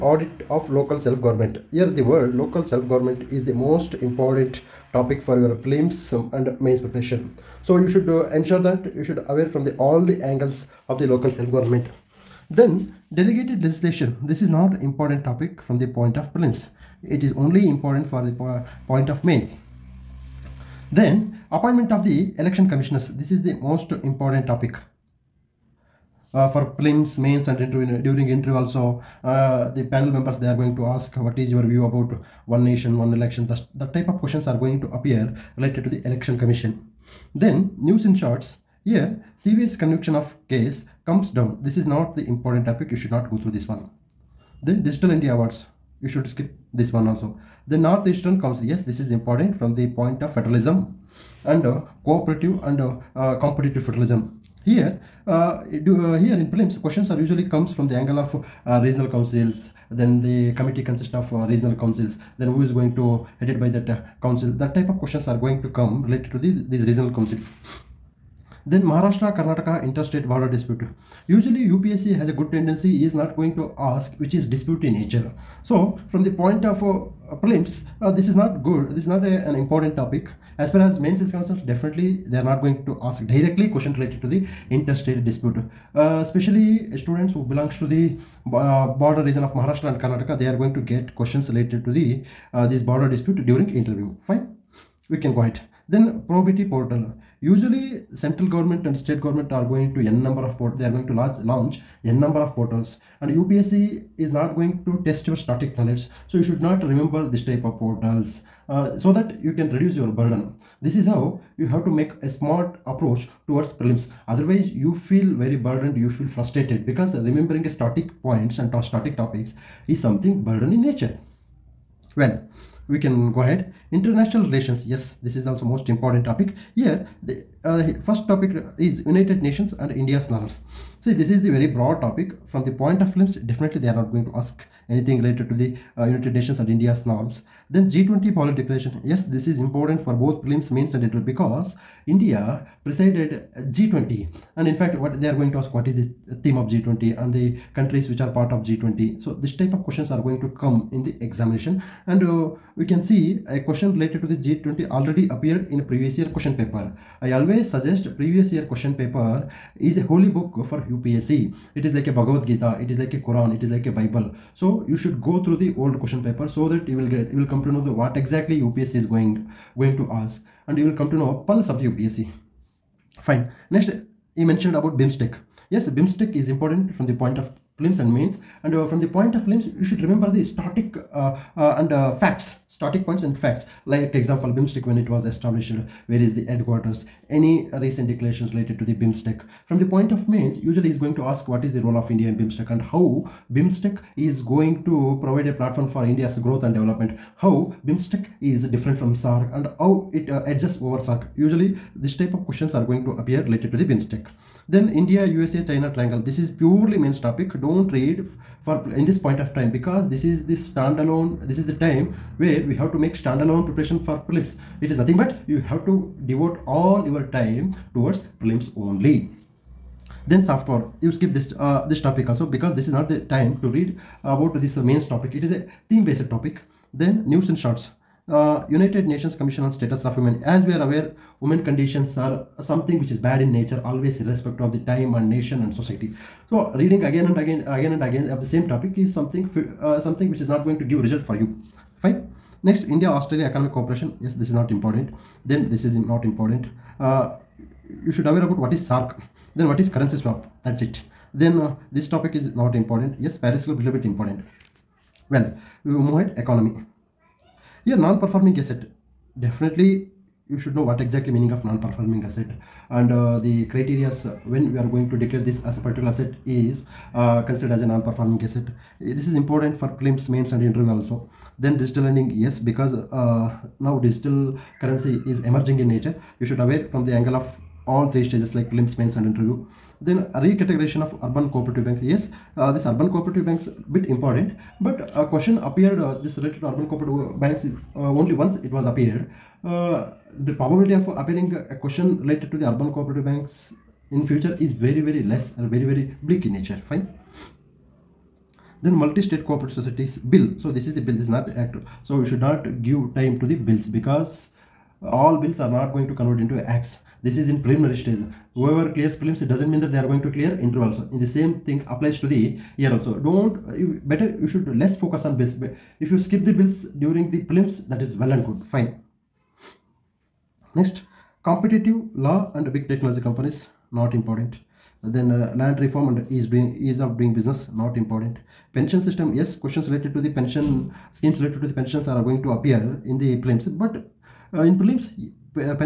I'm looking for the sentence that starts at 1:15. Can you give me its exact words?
So from the point of uh, uh prelims, uh, this is not good.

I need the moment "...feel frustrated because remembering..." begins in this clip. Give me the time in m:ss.
1:56.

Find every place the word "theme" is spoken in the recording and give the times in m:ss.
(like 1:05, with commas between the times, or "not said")
2:26, 3:45.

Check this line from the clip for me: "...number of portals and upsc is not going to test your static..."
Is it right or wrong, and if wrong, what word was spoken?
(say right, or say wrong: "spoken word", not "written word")
right.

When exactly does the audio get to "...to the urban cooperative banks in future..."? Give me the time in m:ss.
4:52.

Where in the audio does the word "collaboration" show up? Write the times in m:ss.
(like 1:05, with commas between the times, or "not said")
not said.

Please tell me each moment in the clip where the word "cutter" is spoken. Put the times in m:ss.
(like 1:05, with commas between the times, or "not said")
not said.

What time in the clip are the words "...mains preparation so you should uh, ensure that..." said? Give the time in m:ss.
0:06.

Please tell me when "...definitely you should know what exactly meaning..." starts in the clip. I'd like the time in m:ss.
4:19.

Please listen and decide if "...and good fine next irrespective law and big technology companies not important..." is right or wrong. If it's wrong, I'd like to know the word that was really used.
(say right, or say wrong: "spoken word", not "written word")
wrong: "competitive", not "irrespective".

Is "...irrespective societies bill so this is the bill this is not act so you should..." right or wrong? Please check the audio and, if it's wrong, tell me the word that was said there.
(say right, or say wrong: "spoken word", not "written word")
wrong: "cooperative", not "irrespective".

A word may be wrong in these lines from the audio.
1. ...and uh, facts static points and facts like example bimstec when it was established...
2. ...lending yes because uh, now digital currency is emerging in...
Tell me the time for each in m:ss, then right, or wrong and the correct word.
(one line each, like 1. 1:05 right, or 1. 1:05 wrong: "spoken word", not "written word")
1. 3:01 right
2. 4:32 right.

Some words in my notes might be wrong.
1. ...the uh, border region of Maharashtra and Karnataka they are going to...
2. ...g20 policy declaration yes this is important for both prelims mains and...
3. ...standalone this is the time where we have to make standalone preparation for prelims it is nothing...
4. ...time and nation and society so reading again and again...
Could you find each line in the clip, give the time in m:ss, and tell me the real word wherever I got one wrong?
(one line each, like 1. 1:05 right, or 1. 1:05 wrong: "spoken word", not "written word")
1. 1:27 right
2. 2:17 right
3. 3:30 right
4. 3:54 right.